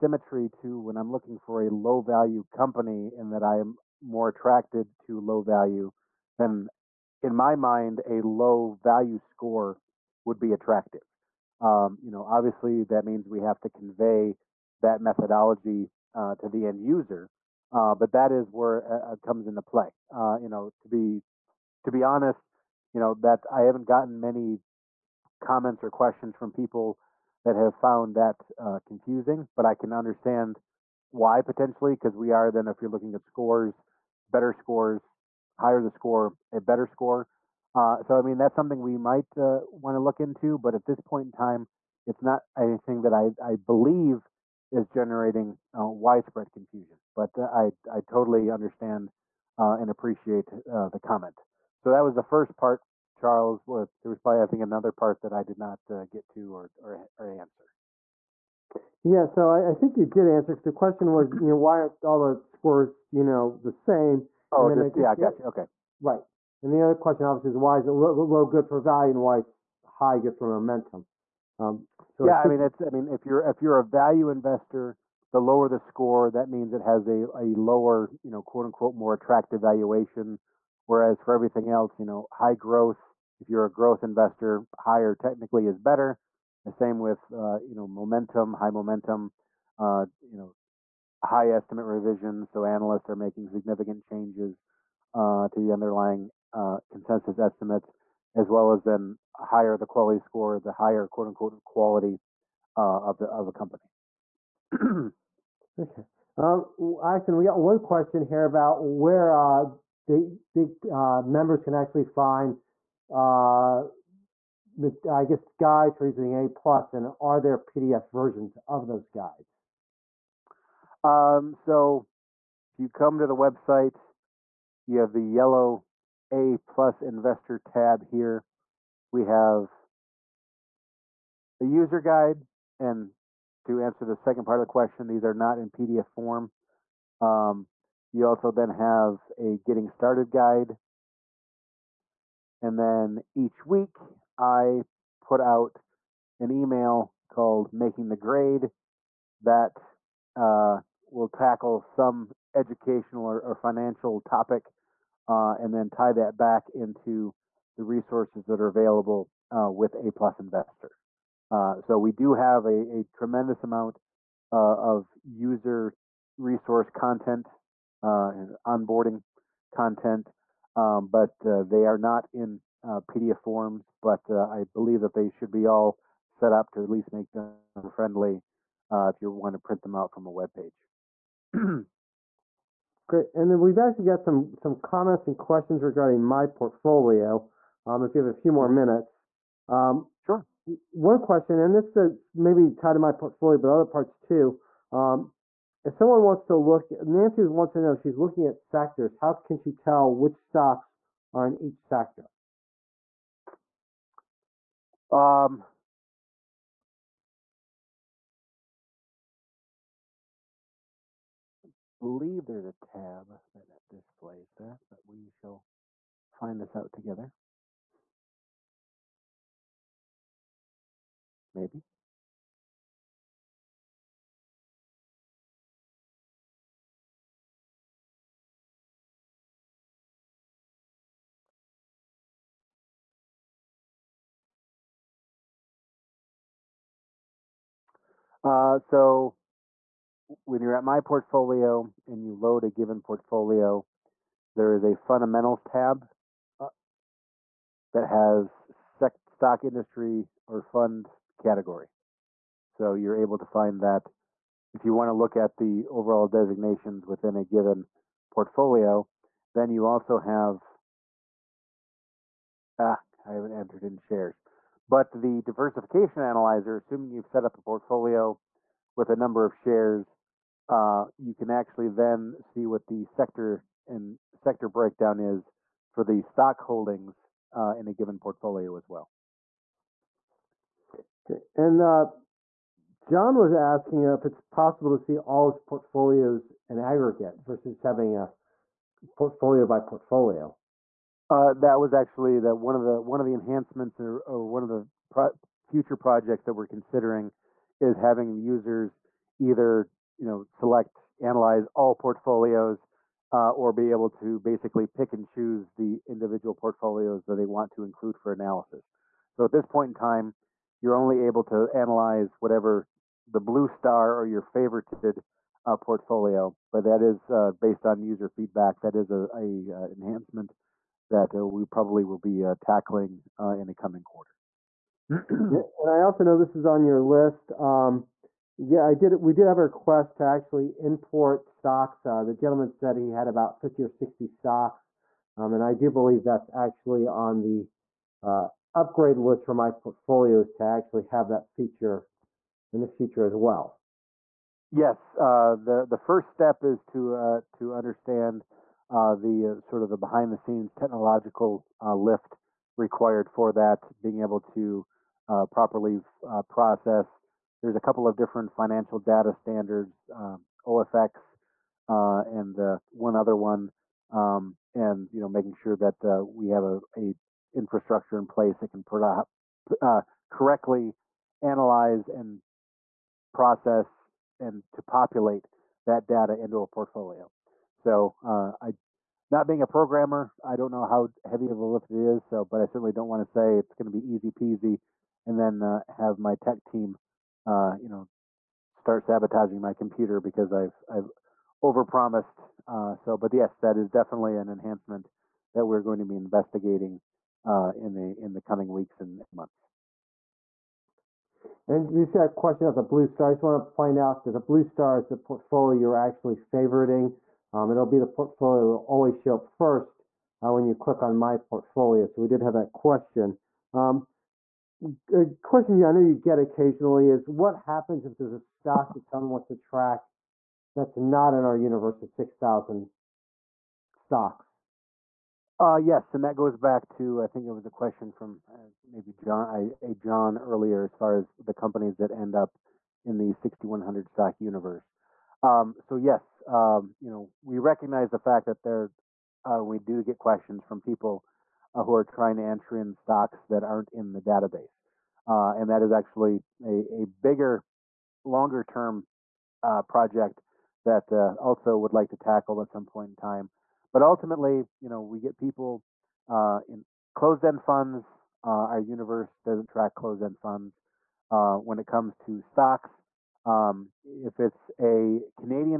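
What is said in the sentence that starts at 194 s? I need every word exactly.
Um, if someone wants to look, Nancy wants to know, she's looking at sectors.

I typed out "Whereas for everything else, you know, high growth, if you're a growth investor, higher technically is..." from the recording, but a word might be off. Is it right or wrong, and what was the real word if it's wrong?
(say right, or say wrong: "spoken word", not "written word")
right.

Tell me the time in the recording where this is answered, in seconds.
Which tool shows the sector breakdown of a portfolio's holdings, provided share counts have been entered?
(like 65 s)
265 s.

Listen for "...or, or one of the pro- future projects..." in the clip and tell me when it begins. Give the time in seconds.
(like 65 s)
294 s.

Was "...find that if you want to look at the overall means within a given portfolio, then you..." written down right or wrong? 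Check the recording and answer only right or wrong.
wrong.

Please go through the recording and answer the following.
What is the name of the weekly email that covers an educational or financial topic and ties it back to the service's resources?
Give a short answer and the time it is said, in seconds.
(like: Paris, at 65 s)
Making the Grade, at 147 s.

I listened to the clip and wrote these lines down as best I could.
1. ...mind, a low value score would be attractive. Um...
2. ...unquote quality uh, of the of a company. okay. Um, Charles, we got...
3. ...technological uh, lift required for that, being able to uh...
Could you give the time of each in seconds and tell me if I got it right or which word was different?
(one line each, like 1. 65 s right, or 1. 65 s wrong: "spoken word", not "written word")
1. 7 s right
2. 101 s wrong: "Acton", not "Charles"
3. 350 s right.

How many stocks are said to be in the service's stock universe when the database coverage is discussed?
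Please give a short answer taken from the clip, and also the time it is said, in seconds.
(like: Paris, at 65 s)
6,100, at 433 s.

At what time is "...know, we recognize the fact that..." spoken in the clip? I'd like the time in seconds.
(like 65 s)
437 s.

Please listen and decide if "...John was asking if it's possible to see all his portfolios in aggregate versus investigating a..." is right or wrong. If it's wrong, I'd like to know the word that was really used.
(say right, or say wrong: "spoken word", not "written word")
wrong: "having", not "investigating".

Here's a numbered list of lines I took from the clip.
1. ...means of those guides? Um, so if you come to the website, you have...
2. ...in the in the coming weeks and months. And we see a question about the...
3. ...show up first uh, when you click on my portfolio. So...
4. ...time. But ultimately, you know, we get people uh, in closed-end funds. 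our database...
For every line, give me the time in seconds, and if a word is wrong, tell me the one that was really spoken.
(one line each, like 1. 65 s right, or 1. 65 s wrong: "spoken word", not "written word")
1. 118 s wrong: "versions", not "means"
2. 397 s right
3. 409 s right
4. 453 s wrong: "universe", not "database".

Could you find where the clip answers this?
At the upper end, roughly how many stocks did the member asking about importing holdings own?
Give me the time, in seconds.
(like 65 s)
333 s.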